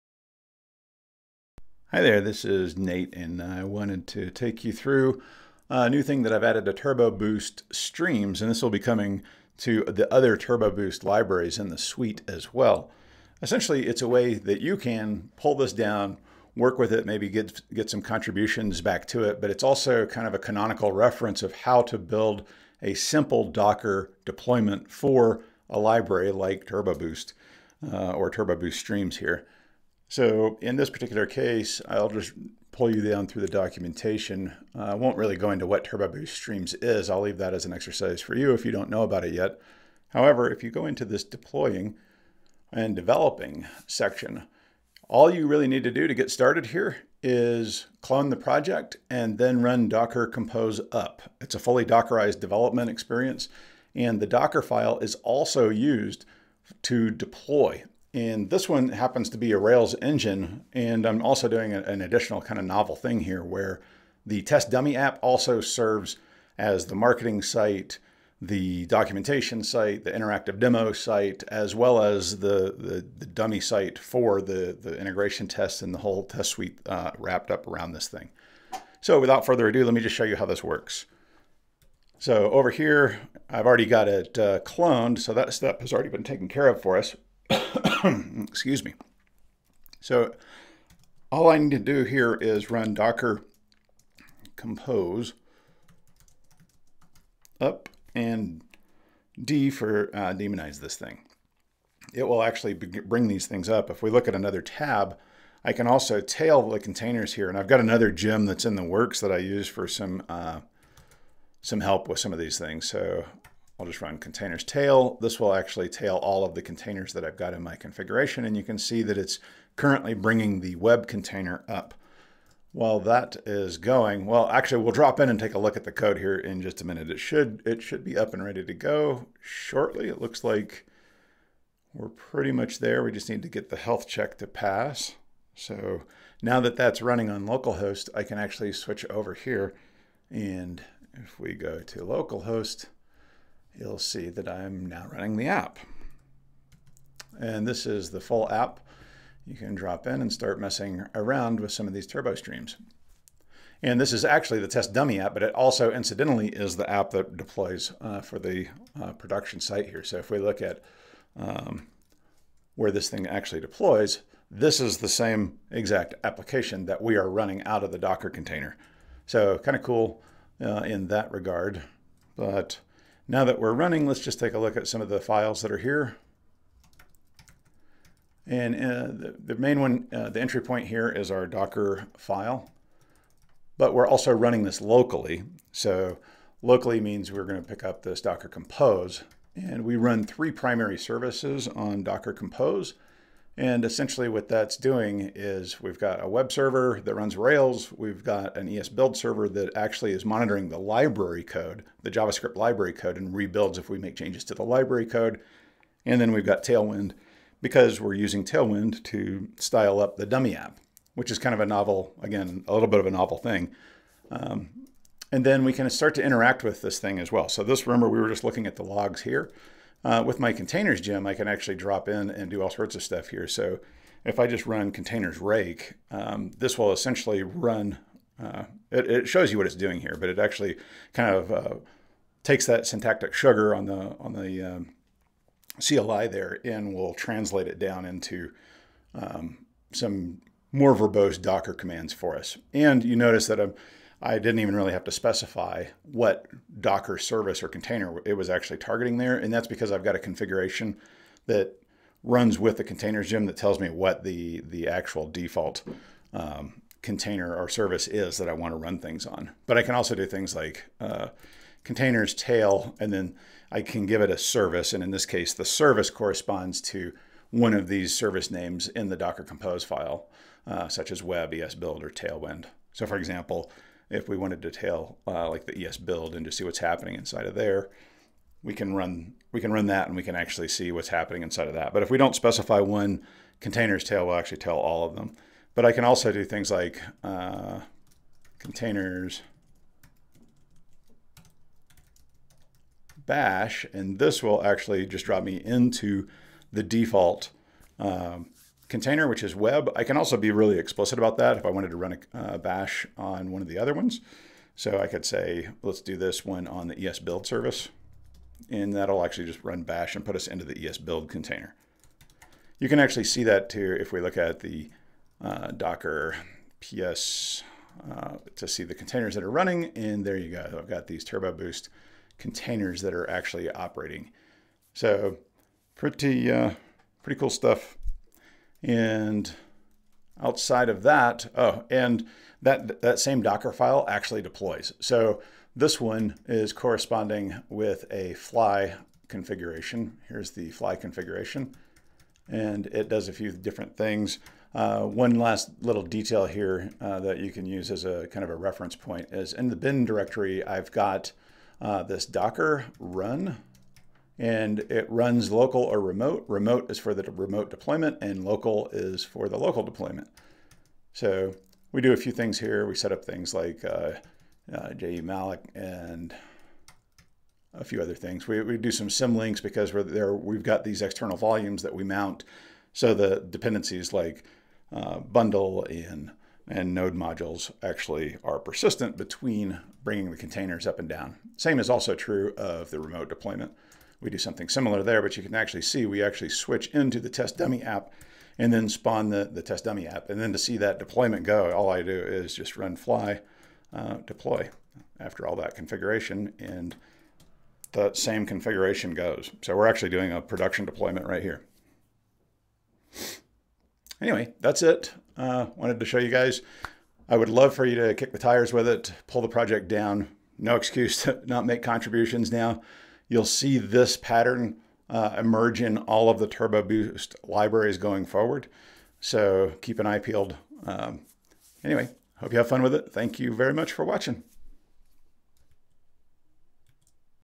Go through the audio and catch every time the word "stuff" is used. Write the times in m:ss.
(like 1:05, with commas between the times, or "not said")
3:43, 5:27.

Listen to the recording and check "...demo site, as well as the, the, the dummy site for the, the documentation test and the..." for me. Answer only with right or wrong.
wrong.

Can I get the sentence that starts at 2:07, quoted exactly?
It should, it should be up and ready to go shortly.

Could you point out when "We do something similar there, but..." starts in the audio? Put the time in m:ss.
6:24.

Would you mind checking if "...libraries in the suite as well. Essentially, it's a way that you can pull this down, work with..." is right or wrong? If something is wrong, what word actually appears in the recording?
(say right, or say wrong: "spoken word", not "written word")
right.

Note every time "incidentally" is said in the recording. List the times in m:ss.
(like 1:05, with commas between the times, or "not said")
2:35.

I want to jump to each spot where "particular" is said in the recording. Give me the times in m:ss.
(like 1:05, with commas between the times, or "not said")
0:30.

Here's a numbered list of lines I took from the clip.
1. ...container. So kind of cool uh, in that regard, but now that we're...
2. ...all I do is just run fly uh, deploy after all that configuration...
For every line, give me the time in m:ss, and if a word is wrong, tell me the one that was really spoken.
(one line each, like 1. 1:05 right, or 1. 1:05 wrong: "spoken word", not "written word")
1. 2:48 right
2. 6:31 right.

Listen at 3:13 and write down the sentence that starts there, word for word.
And essentially what that's doing is we've got a web server that runs Rails.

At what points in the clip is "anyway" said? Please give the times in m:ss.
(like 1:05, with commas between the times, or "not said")
6:44, 7:01.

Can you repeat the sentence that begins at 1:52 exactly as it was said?
So I'll just run containers tail.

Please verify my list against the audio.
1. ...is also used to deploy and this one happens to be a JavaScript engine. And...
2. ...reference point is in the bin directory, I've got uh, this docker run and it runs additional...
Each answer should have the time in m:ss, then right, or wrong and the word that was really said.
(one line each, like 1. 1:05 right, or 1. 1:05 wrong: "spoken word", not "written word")
1. 0:54 wrong: "Rails", not "JavaScript"
2. 5:48 wrong: "local", not "additional".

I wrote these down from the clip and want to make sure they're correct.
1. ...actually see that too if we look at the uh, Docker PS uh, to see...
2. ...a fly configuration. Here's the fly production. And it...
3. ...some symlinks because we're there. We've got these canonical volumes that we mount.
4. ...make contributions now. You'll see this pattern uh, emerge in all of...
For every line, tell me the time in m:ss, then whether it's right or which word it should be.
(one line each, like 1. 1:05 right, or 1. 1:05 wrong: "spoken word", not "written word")
1. 5:12 right
2. 5:38 wrong: "configuration", not "production"
3. 6:08 wrong: "external", not "canonical"
4. 6:51 right.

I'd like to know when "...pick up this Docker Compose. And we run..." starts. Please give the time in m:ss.
3:07.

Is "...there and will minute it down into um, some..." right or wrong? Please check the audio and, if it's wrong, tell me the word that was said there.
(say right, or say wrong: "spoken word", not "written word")
wrong: "translate", not "minute".